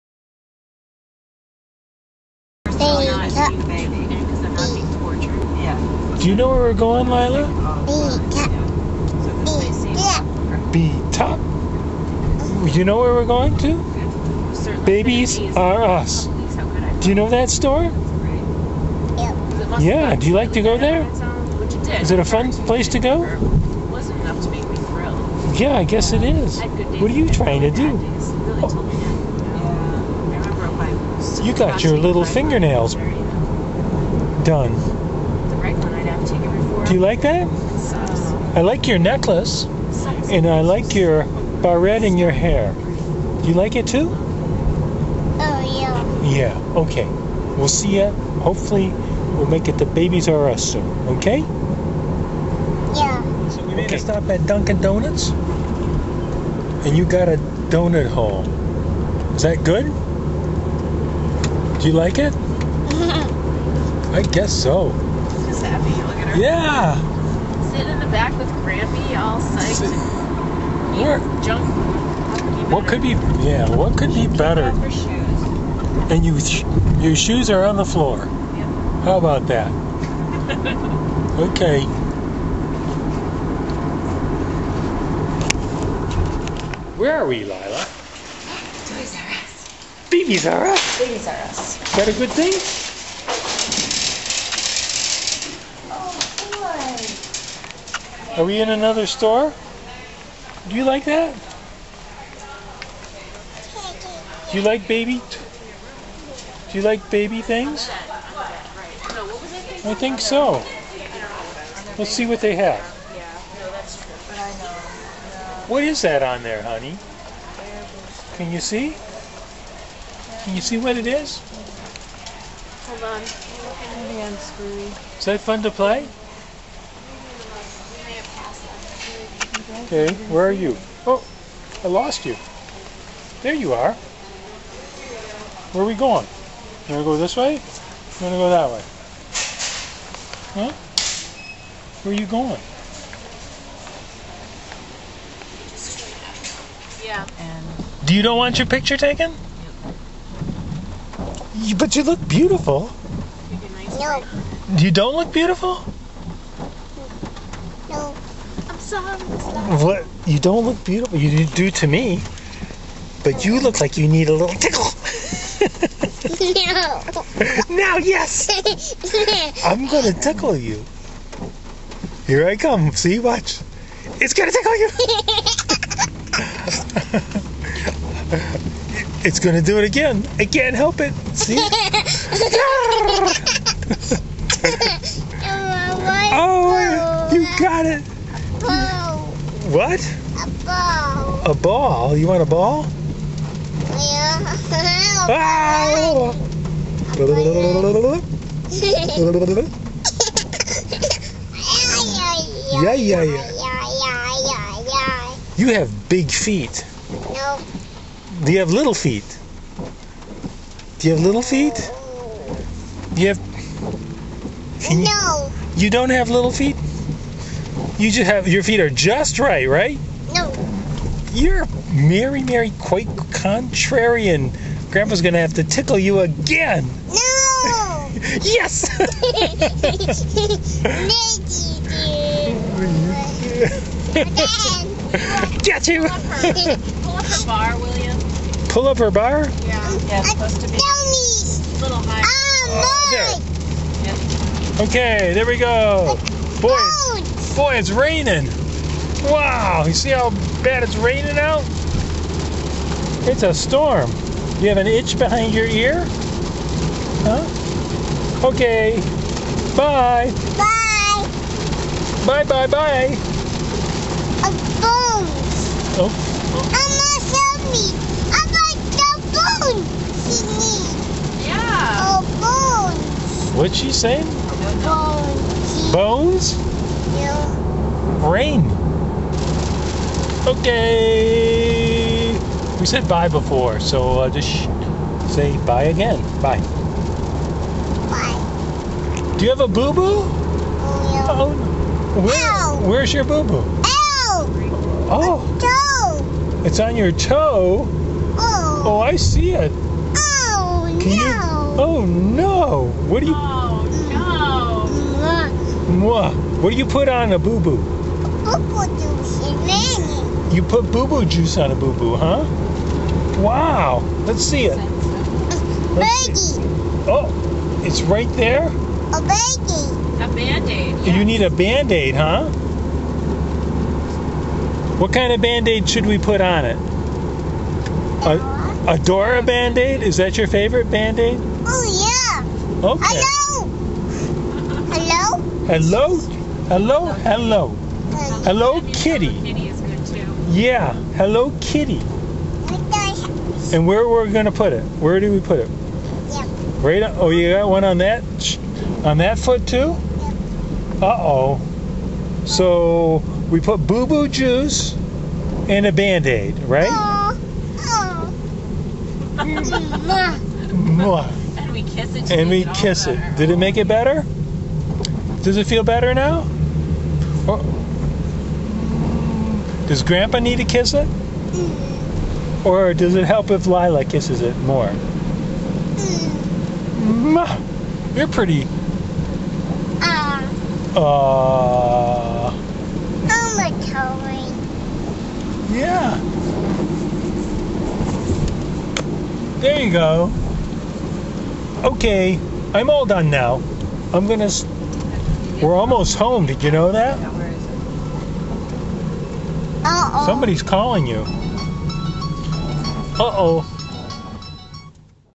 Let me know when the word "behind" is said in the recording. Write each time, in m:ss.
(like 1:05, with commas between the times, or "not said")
4:15.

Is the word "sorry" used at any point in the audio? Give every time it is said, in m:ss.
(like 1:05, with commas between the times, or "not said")
2:38.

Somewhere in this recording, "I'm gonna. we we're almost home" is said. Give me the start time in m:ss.
6:34.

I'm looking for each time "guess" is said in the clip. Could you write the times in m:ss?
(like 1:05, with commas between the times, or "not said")
0:25, 1:04.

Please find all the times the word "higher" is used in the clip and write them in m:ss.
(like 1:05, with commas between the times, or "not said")
4:02.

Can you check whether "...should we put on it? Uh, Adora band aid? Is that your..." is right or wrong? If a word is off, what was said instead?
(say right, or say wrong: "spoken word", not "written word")
right.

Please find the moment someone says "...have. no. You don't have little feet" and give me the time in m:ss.
3:33.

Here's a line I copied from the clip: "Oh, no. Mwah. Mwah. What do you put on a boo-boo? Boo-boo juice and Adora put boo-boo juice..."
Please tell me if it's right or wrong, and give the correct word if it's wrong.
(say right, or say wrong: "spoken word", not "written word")
wrong: "You", not "Adora".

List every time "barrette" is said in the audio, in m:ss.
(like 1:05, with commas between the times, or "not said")
0:41.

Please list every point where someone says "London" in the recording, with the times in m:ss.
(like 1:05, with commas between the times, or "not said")
not said.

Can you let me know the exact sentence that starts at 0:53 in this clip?
a stop at Dunkin' Donuts, and you got a donut hole.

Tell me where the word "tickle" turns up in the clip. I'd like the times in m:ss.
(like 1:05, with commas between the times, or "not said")
2:44, 2:50, 2:57, 3:45.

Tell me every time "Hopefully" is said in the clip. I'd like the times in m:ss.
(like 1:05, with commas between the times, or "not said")
0:48.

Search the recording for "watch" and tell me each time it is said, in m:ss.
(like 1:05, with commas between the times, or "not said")
2:53.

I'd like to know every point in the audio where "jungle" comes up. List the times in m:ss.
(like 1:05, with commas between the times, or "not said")
not said.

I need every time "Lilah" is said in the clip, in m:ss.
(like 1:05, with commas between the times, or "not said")
0:07, 1:27, 6:13.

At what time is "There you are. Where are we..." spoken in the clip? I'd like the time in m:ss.
2:13.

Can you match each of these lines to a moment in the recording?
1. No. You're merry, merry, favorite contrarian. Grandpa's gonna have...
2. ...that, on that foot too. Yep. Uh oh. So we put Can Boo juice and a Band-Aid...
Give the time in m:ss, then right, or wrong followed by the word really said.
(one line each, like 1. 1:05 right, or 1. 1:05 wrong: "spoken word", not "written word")
1. 3:40 wrong: "quite", not "favorite"
2. 5:47 wrong: "Boo", not "Can".